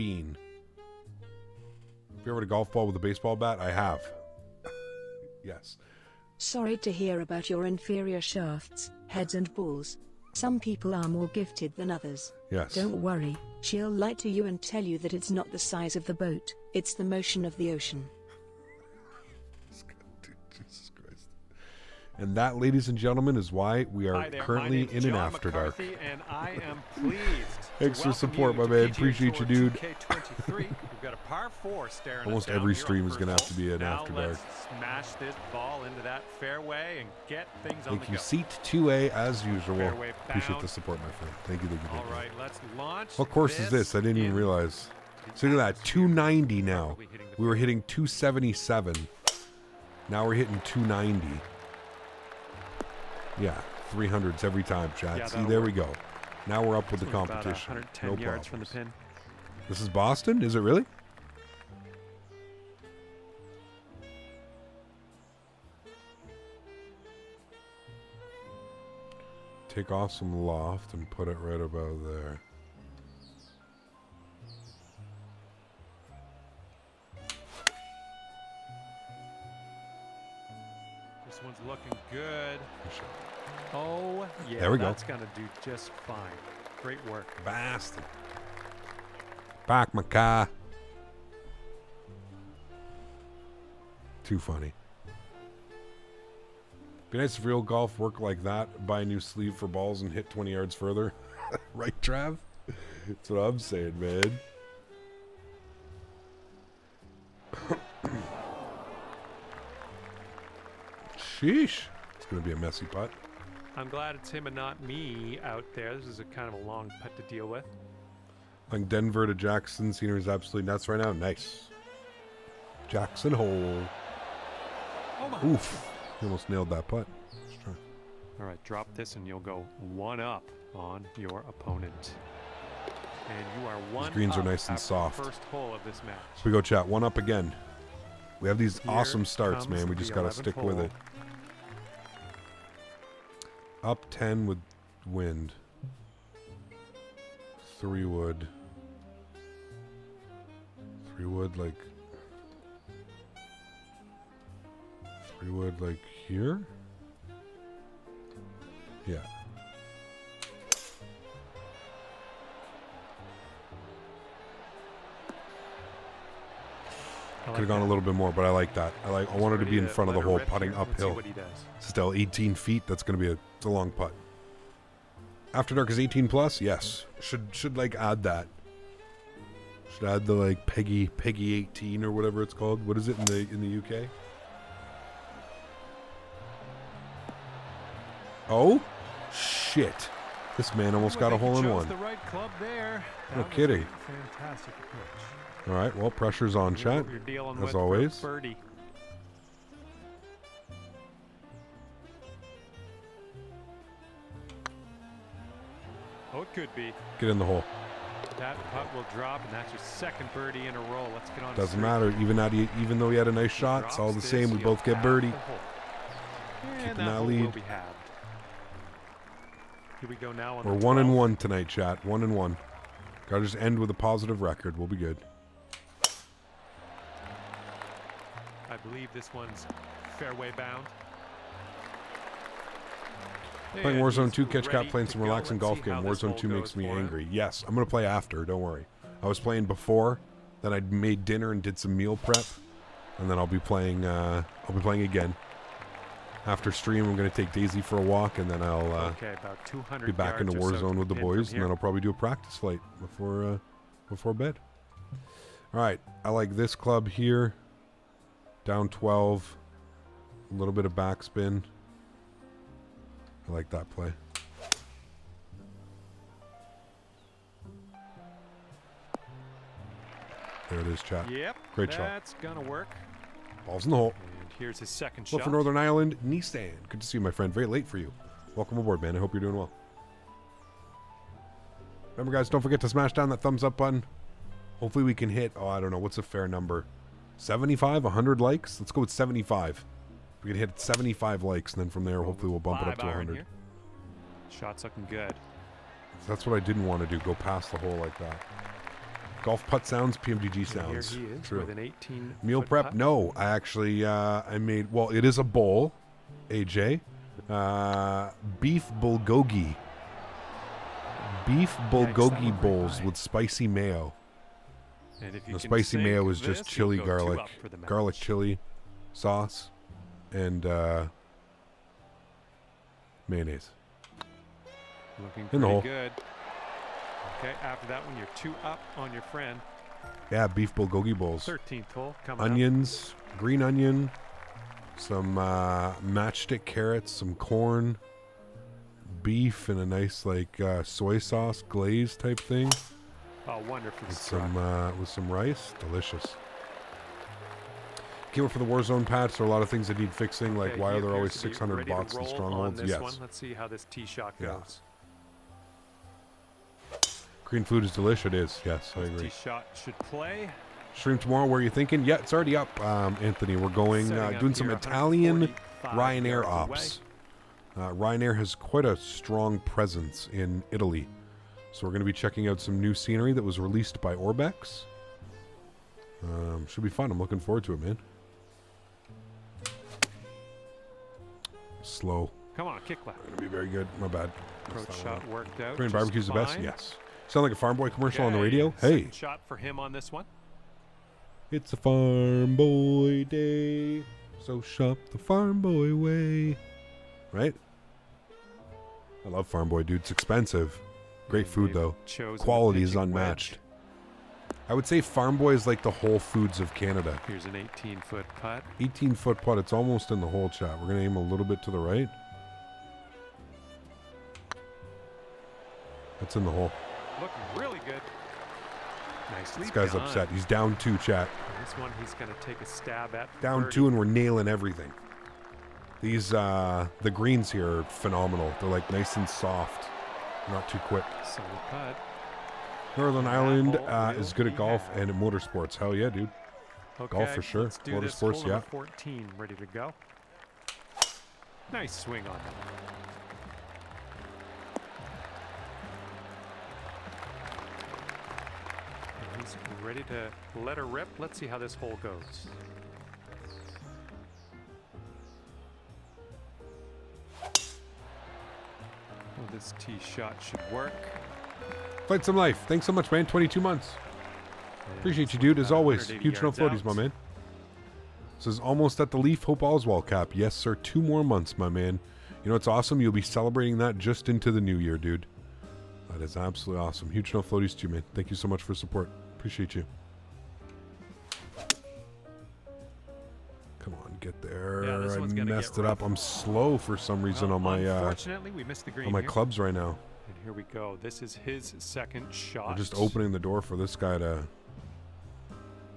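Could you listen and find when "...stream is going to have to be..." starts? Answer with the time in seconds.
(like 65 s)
32 s.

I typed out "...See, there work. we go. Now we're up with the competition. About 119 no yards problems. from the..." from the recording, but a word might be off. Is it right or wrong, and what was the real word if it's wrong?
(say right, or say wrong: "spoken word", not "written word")
wrong: "110", not "119".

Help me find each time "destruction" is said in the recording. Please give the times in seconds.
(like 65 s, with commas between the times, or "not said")
not said.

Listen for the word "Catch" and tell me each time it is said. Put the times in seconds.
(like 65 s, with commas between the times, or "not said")
234 s.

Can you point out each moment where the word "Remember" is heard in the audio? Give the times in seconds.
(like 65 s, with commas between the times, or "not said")
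282 s.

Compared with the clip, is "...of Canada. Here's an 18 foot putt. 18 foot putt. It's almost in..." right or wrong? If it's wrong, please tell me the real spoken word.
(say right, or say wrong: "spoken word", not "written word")
right.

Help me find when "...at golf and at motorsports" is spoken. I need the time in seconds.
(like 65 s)
434 s.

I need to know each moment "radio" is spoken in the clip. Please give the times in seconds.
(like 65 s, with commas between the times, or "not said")
388 s.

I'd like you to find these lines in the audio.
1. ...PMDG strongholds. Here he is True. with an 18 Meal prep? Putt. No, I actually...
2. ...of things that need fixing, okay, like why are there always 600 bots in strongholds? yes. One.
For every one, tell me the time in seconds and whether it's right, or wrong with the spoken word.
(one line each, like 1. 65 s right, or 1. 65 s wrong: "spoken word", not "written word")
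1. 300 s wrong: "sounds", not "strongholds"
2. 349 s right.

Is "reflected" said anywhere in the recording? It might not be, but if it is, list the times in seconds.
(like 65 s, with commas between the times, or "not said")
not said.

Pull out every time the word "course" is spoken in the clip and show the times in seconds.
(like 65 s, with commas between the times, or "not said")
43 s.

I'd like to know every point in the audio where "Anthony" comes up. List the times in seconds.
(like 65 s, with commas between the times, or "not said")
363 s.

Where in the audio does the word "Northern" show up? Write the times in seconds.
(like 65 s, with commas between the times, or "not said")
275 s, 432 s.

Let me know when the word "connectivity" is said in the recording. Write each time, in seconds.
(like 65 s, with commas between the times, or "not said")
not said.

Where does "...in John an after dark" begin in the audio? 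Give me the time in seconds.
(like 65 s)
24 s.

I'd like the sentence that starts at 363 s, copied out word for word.
We're going uh, doing some Italian Ryanair ops.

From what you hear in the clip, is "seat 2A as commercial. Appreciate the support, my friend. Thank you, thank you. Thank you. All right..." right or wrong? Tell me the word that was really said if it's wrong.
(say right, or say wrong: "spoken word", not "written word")
wrong: "usual", not "commercial".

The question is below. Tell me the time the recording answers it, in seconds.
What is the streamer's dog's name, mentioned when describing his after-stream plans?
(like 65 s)
247 s.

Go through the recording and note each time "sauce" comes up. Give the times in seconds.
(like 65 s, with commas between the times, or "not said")
319 s, 341 s.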